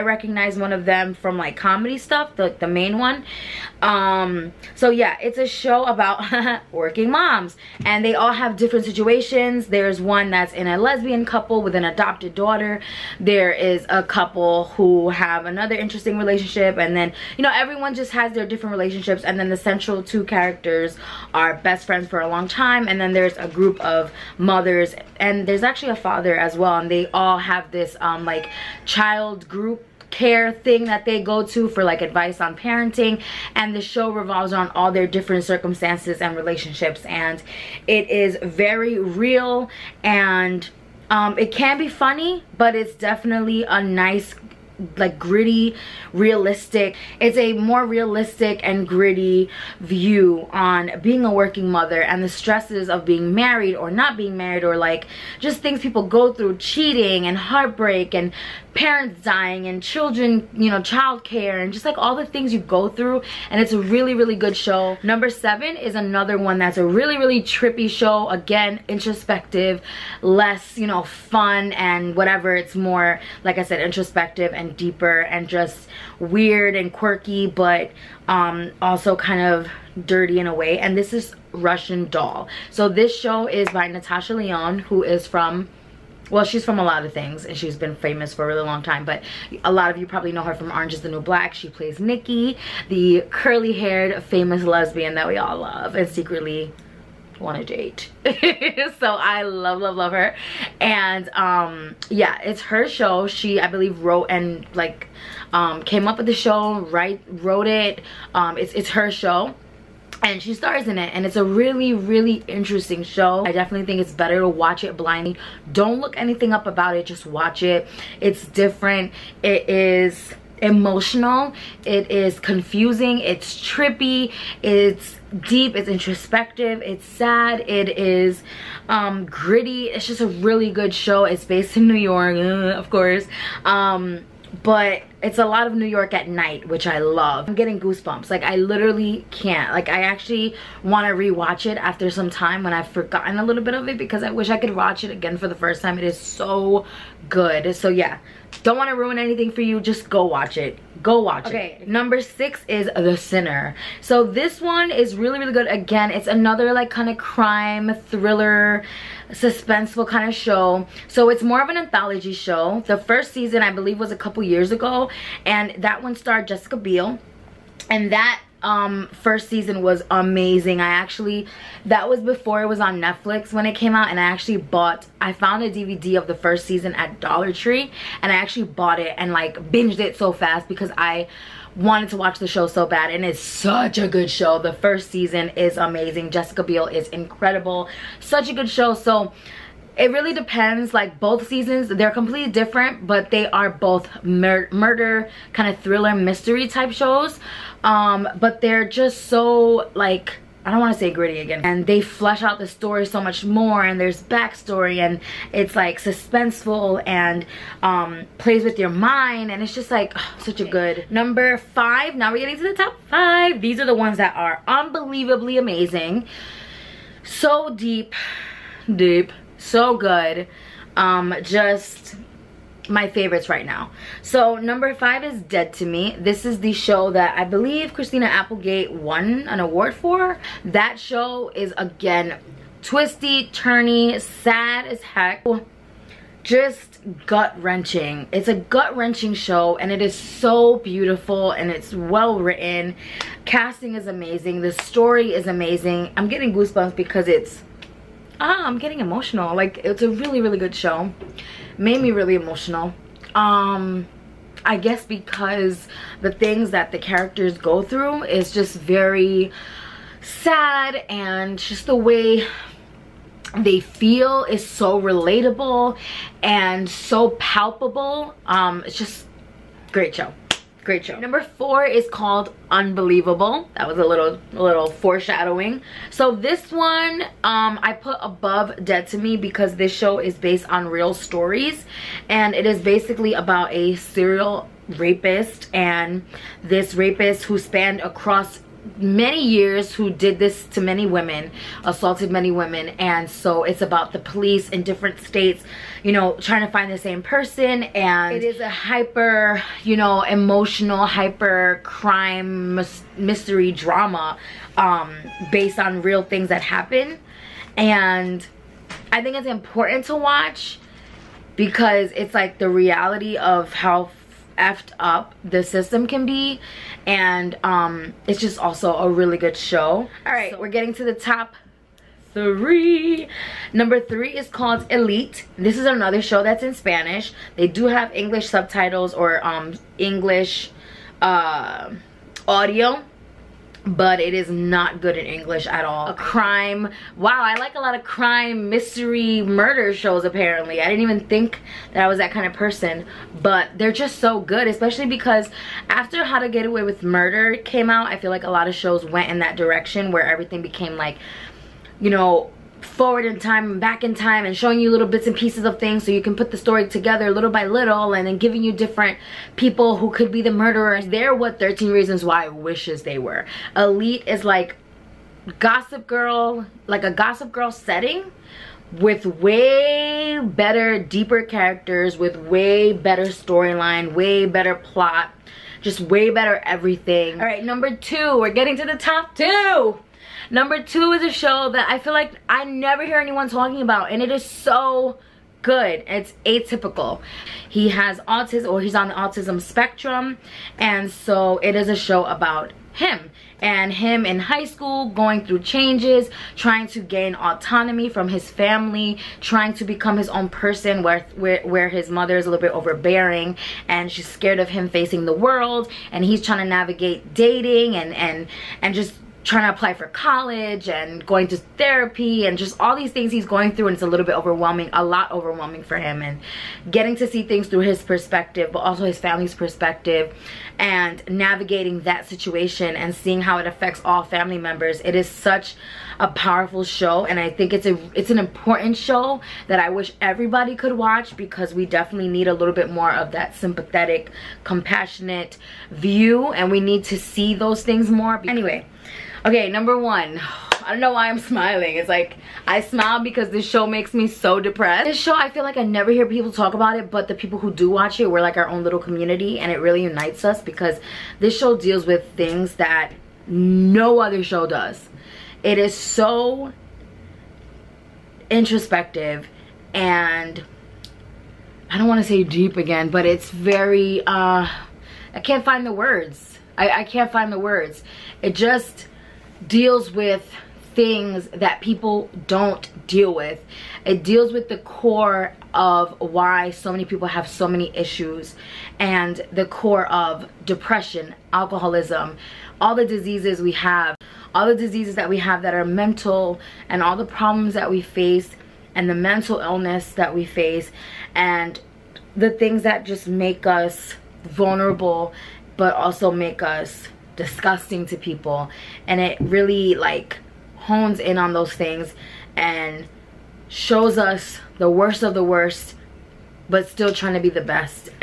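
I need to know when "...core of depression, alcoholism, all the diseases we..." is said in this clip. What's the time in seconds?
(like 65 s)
479 s.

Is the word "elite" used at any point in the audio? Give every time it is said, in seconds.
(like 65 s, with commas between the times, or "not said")
324 s, 363 s.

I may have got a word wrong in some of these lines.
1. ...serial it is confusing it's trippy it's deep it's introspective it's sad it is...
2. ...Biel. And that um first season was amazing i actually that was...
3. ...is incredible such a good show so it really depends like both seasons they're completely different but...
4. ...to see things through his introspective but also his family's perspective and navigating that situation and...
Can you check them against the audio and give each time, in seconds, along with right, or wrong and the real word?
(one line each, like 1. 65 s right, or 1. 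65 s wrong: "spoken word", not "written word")
1. 120 s wrong: "emotional", not "serial"
2. 166 s right
3. 186 s right
4. 417 s wrong: "perspective", not "introspective".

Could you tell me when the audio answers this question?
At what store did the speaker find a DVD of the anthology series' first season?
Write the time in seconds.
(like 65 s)
177 s.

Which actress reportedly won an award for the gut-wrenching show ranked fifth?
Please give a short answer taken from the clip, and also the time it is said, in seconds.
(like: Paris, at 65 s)
Christina Applegate, at 227 s.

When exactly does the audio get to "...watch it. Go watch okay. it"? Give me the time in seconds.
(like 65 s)
150 s.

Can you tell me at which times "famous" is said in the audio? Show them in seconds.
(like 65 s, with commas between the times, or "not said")
87 s, 94 s.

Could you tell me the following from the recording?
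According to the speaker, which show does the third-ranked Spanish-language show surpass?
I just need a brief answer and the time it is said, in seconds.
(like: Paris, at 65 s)
13 Reasons Why, at 361 s.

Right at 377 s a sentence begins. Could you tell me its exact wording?
All right, number two, we're getting to the top two.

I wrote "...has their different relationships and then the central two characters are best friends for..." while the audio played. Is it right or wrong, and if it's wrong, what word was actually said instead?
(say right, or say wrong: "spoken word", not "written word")
right.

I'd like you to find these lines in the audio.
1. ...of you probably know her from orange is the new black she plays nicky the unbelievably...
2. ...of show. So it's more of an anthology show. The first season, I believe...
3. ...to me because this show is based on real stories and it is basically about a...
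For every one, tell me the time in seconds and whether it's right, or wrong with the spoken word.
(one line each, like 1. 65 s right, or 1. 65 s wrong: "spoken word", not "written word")
1. 89 s wrong: "curly", not "unbelievably"
2. 160 s right
3. 279 s right.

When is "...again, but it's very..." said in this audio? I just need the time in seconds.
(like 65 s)
462 s.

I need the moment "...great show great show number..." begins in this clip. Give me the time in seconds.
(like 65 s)
269 s.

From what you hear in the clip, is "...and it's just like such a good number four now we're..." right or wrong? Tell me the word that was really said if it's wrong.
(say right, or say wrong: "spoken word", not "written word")
wrong: "five", not "four".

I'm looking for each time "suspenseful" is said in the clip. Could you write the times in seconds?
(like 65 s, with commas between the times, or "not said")
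159 s, 205 s.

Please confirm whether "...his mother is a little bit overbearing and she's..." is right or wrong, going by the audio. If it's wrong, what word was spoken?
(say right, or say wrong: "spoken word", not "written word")
right.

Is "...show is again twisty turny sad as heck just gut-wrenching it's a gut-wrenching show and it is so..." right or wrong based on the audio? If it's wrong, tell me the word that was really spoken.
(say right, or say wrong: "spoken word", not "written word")
right.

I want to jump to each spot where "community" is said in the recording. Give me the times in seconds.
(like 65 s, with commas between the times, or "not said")
448 s.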